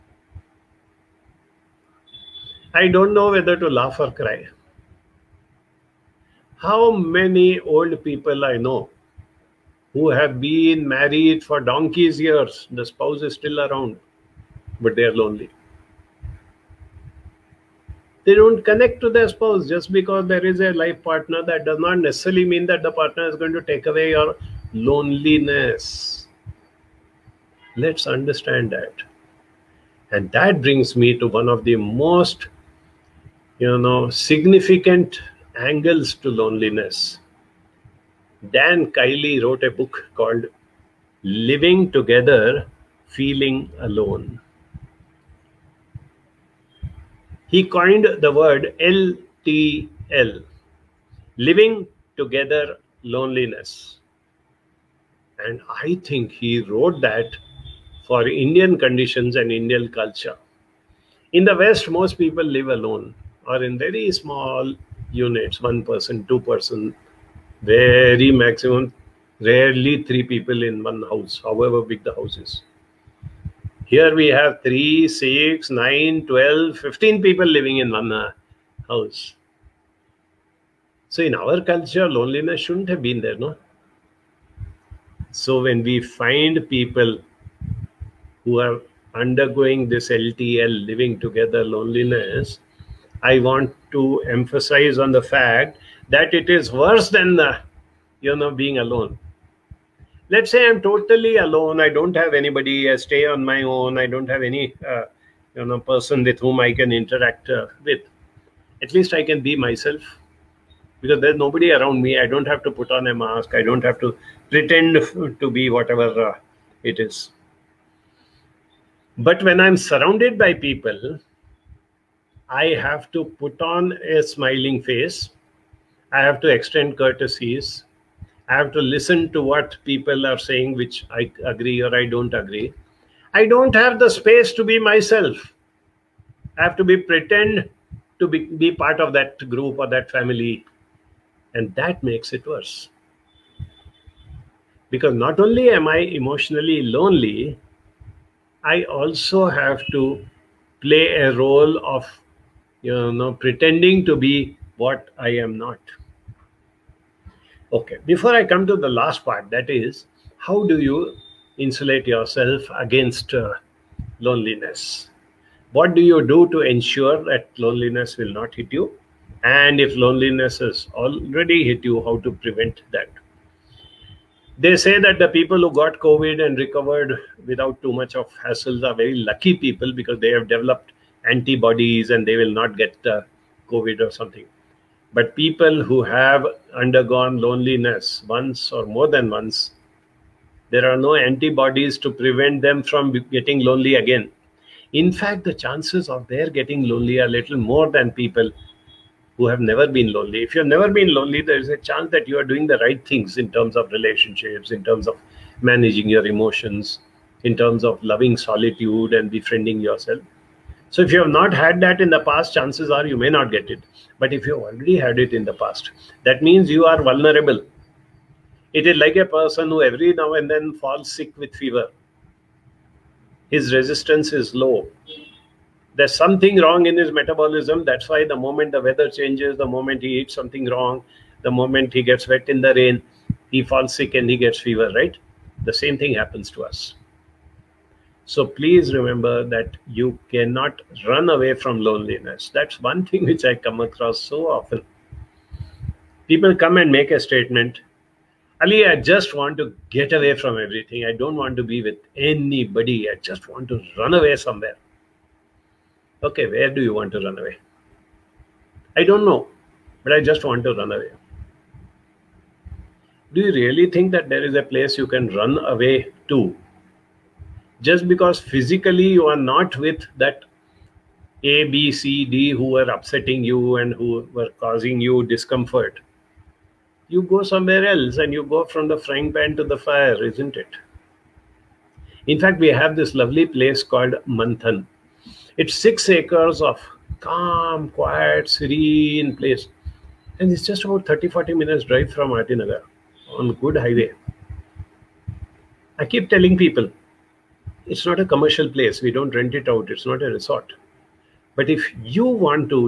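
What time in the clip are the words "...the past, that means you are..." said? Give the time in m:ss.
3:35.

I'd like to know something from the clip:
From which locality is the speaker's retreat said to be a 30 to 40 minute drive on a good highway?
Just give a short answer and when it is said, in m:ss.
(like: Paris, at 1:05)
RT Nagar, at 4:52.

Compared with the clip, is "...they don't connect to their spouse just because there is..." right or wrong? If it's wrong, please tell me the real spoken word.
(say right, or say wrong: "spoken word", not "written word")
right.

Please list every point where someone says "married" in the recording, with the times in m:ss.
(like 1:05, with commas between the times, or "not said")
0:10.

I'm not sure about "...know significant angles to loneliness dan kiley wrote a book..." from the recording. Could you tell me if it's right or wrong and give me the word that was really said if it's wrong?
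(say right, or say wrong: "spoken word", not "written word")
right.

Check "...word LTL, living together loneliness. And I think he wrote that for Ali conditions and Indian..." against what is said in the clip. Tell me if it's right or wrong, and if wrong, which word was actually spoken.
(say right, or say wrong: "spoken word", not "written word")
wrong: "Indian", not "Ali".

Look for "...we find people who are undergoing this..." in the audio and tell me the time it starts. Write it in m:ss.
1:25.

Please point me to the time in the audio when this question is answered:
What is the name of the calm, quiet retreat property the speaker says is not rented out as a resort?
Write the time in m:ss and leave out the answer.
4:44.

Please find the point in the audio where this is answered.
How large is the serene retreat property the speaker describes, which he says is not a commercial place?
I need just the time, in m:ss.
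4:45.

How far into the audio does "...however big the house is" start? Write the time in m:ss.
1:11.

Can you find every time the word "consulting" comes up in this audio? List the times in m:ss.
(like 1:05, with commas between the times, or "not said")
not said.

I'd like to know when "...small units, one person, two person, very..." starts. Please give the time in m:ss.
1:04.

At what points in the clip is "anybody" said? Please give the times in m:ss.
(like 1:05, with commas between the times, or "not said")
1:42, 4:12.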